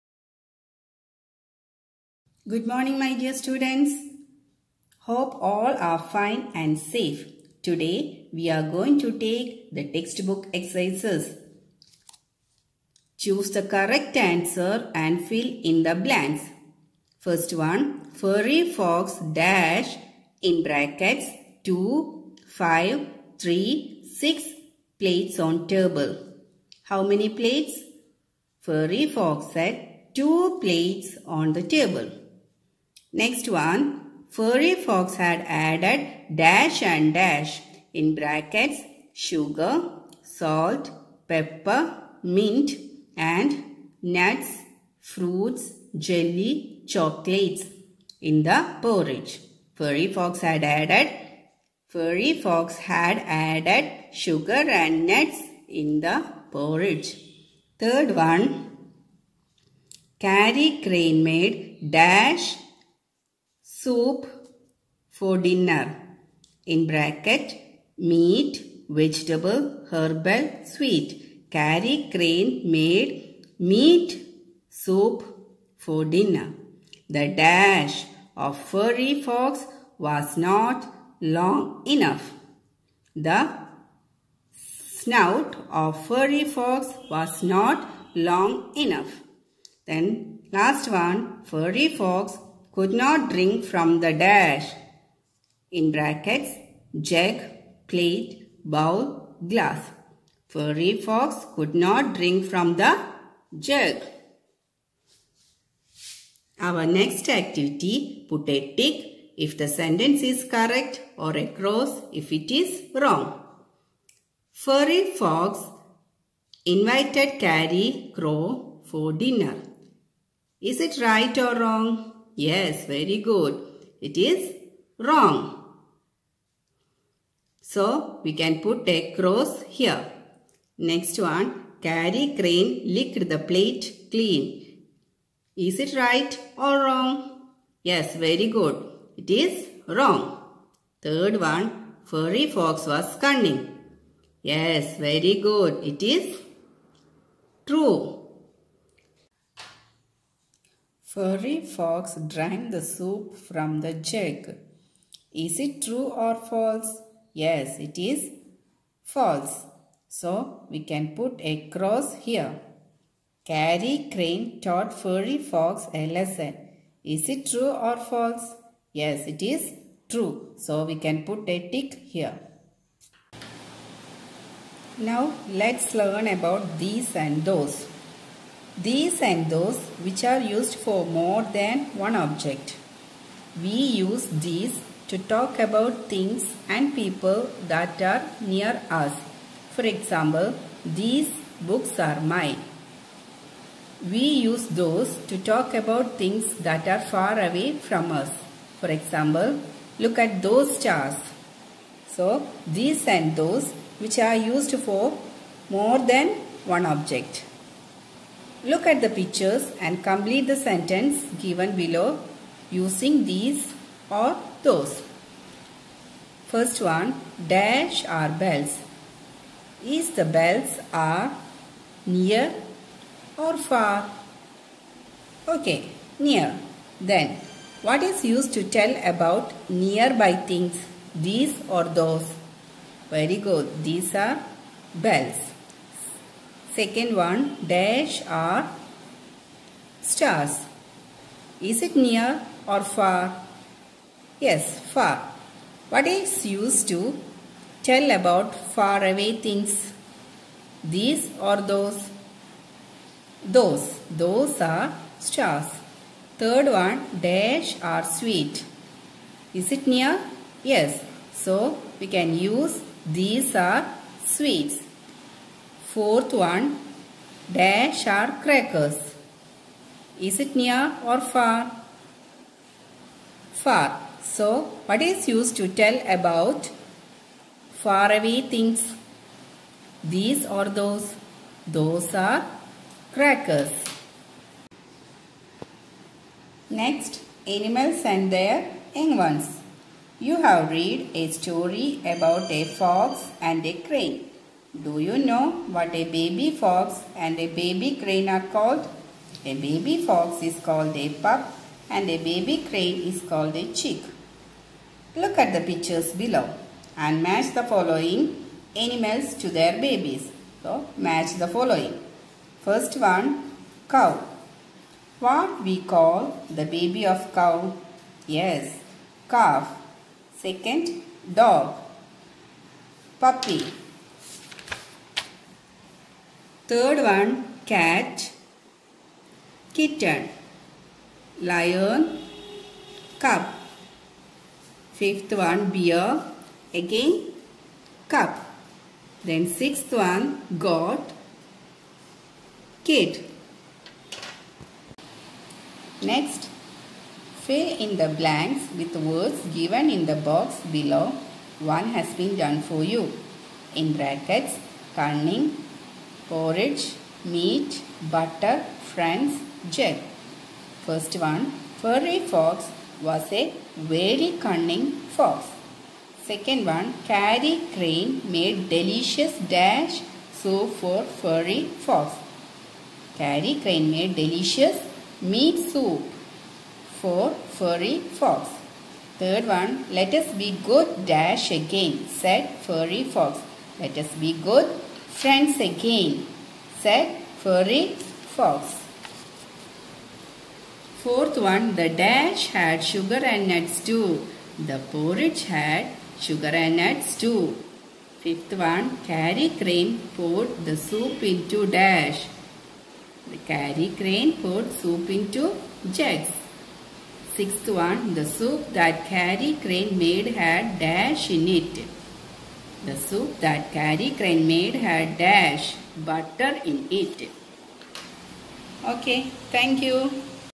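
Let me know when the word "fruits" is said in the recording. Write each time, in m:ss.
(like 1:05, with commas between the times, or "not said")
0:45.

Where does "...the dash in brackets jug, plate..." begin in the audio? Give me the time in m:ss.
1:33.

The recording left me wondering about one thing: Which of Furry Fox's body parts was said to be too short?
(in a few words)
Snout.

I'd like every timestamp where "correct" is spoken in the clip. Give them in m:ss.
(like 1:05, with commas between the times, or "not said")
0:13, 1:50.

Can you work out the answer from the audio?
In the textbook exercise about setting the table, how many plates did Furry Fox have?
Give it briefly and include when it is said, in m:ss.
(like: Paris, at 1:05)
2, at 0:28.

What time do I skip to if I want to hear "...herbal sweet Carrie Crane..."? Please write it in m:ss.
1:09.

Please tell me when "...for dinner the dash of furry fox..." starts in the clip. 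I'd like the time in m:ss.
1:15.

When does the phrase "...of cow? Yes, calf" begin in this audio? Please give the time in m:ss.
5:17.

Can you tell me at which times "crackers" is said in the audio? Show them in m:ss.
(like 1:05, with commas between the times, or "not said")
4:28, 4:43.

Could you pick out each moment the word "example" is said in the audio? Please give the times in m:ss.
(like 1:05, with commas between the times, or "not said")
3:09, 3:18.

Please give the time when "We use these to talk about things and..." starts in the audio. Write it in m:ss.
3:03.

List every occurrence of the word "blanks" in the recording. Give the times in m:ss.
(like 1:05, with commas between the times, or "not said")
0:15, 5:48.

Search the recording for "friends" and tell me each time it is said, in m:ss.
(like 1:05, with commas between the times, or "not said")
5:58, 6:25.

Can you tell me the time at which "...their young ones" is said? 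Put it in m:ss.
4:48.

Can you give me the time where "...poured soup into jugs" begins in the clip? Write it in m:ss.
6:44.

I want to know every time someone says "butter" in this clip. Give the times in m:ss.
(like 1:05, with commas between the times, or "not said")
5:58, 6:56.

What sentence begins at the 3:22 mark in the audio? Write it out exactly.
So, these and those which are used for more than one object.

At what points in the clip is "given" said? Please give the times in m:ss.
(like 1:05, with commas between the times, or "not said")
3:31, 5:49.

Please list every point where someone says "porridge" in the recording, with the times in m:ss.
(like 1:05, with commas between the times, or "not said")
0:48, 0:56, 5:56, 6:34.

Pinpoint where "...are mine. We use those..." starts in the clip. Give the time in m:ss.
3:11.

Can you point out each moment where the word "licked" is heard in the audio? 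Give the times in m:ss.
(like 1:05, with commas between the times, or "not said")
2:12.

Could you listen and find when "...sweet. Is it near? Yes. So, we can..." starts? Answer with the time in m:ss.
4:18.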